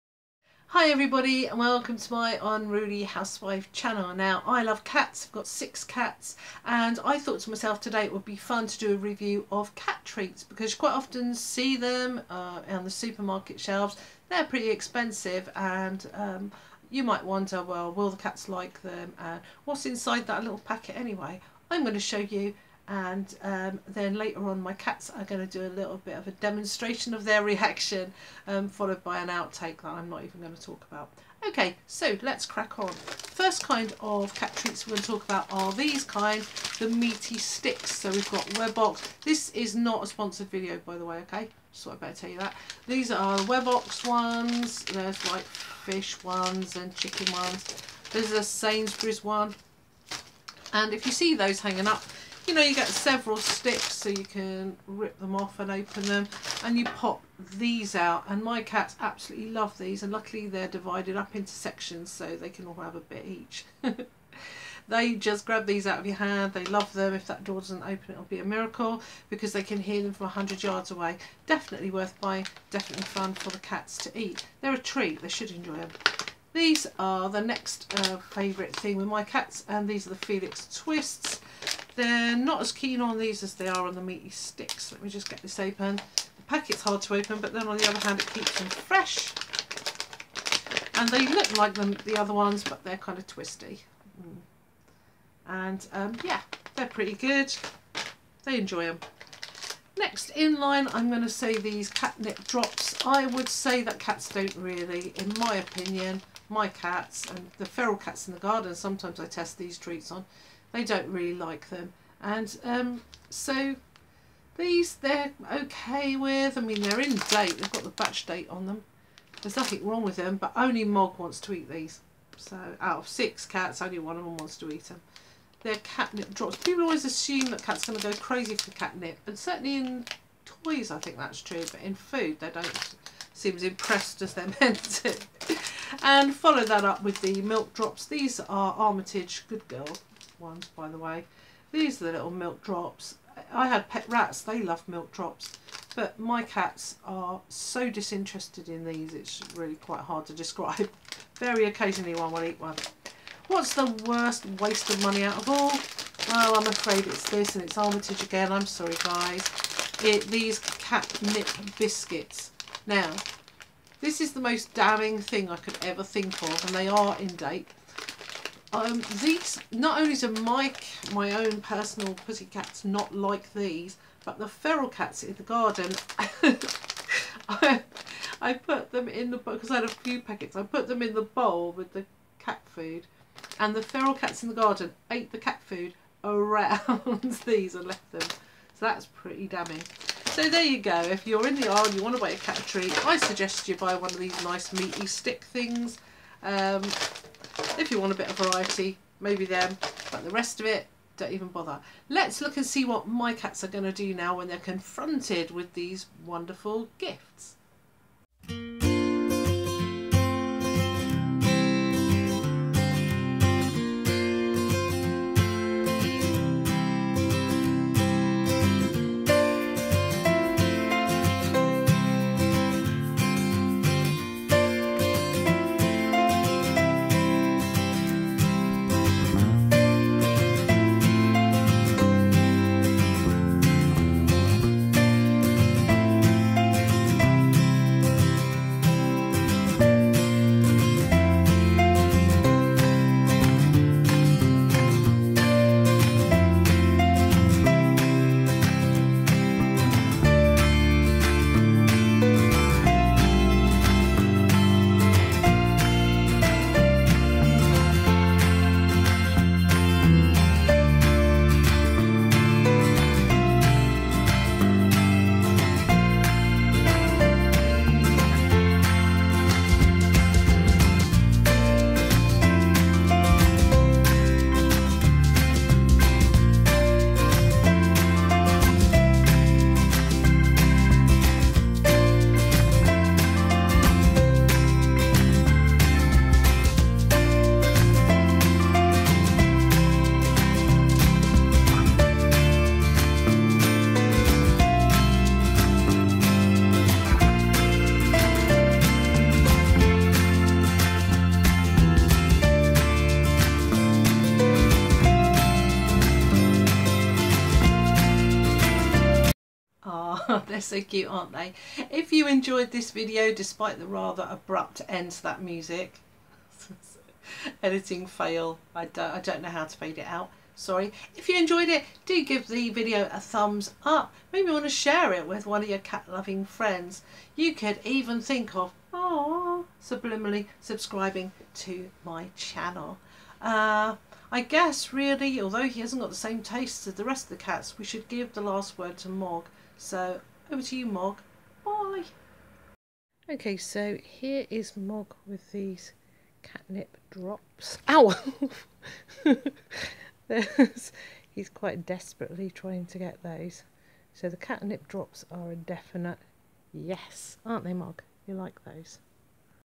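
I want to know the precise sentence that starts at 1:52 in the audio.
And um, so these they're okay with.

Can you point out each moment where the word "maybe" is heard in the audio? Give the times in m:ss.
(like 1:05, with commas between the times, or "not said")
3:19, 5:24.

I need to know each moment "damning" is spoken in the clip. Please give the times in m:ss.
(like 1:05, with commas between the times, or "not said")
2:44, 3:09.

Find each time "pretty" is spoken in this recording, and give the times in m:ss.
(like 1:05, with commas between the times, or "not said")
0:14, 1:36, 3:09.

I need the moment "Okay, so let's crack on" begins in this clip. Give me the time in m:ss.
0:31.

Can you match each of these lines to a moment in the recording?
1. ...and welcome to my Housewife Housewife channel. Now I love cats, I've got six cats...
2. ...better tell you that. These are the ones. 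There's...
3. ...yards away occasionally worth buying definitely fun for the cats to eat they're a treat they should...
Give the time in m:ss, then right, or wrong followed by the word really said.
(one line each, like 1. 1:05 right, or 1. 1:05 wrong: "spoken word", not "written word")
1. 0:01 wrong: "Unruly", not "Housewife"
2. 0:42 right
3. 1:10 wrong: "definitely", not "occasionally".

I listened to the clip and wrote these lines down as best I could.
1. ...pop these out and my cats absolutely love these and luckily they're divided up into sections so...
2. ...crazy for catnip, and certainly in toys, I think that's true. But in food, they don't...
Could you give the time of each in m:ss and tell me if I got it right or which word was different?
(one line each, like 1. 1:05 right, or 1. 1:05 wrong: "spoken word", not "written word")
1. 0:56 right
2. 2:08 right.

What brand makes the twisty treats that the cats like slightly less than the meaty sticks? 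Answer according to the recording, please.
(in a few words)
Felix.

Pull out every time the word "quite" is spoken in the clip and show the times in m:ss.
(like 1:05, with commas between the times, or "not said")
0:10, 2:29, 5:51.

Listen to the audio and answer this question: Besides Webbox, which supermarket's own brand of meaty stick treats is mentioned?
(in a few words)
Sainsbury's.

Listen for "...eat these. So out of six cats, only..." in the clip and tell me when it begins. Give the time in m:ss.
2:01.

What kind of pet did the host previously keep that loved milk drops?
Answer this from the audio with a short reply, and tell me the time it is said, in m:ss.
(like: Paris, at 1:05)
Rats, at 2:23.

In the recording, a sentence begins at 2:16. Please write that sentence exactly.
and follow that up with the milk drops.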